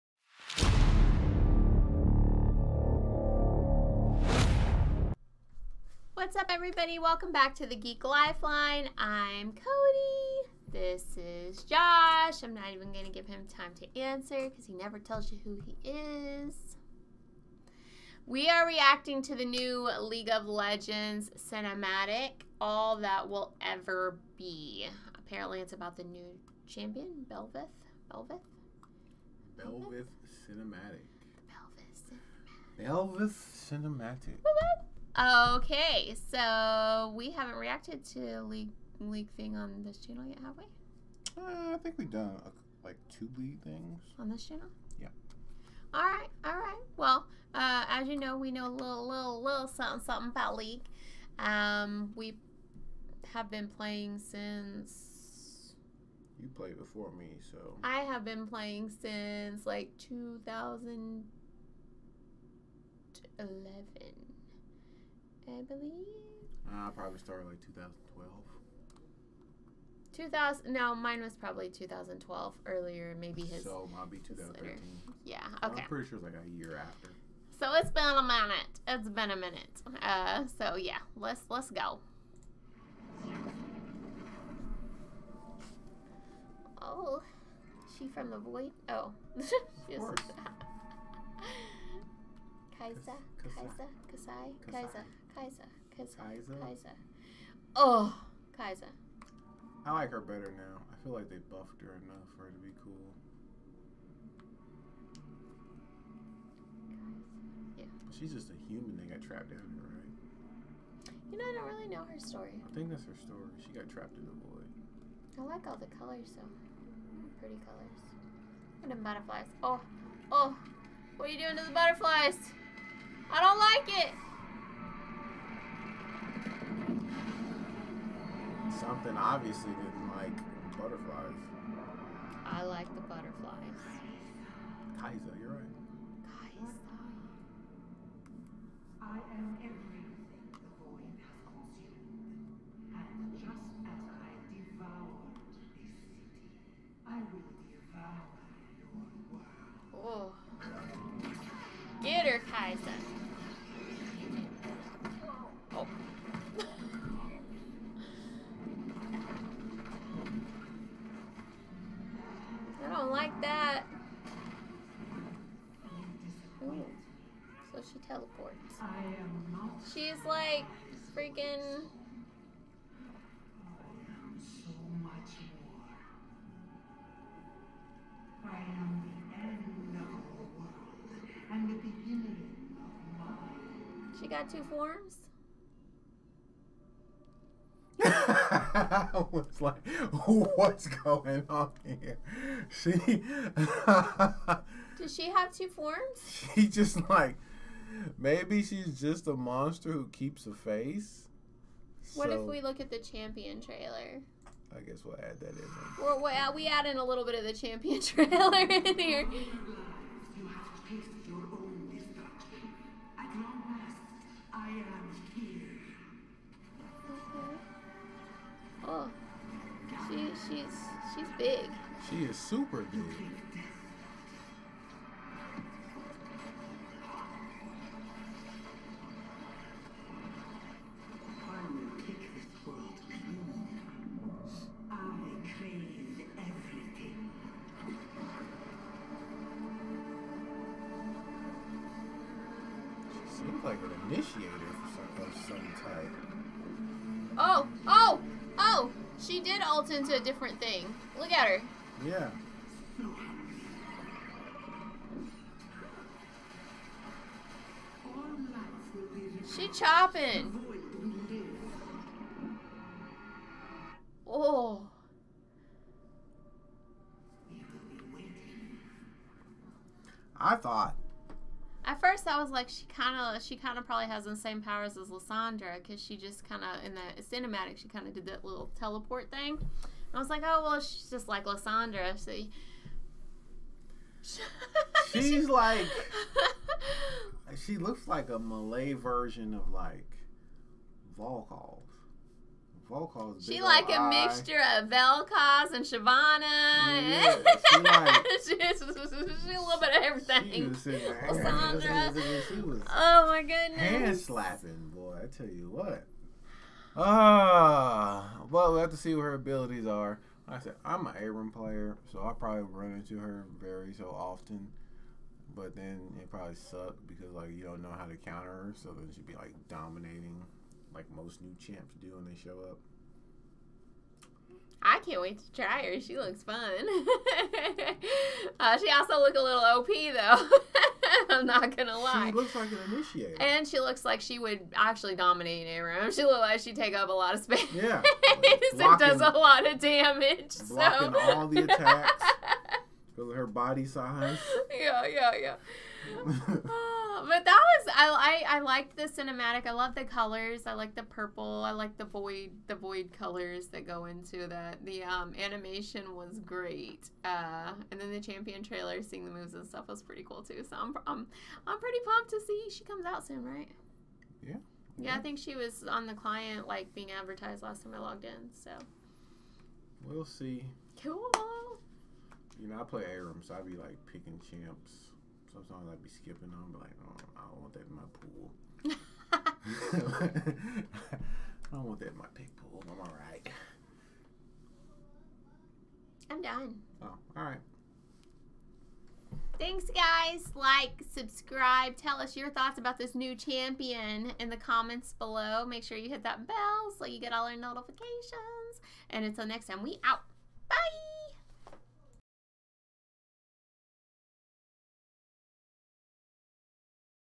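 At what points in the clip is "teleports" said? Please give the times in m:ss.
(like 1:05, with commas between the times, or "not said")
2:47, 4:38.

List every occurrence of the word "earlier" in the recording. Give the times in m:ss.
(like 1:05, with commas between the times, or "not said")
1:12.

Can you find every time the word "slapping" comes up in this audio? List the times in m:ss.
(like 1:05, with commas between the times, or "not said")
5:04.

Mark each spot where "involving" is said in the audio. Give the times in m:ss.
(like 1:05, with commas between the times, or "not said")
not said.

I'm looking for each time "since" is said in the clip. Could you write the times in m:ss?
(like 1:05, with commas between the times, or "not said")
0:54, 0:59.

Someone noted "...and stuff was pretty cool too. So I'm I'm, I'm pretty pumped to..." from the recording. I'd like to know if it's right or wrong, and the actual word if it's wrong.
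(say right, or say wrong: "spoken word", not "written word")
right.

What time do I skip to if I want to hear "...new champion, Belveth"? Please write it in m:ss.
0:26.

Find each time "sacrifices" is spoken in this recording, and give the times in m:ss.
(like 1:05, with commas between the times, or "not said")
not said.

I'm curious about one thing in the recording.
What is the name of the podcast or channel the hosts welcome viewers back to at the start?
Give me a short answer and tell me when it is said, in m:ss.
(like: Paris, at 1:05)
Geek Lifeline, at 0:07.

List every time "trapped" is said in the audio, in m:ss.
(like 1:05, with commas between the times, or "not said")
1:49, 1:53.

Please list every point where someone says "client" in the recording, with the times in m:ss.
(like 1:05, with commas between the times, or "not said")
6:06.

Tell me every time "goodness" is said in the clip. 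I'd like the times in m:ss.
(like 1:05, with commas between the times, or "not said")
5:03.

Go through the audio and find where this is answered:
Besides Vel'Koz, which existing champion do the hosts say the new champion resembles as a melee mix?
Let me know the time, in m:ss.
4:55.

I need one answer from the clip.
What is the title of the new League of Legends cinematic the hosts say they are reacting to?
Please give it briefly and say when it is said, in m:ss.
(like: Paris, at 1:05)
All That Will Ever Be, at 0:22.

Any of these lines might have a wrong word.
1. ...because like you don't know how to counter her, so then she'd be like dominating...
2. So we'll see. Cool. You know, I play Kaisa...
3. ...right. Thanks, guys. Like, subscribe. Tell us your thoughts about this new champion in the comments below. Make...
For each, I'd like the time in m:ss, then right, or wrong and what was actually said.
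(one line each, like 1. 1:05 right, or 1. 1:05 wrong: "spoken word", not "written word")
1. 5:17 right
2. 6:08 wrong: "Aram", not "Kaisa"
3. 6:27 right.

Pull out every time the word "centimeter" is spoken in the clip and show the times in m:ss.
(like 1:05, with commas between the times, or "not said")
not said.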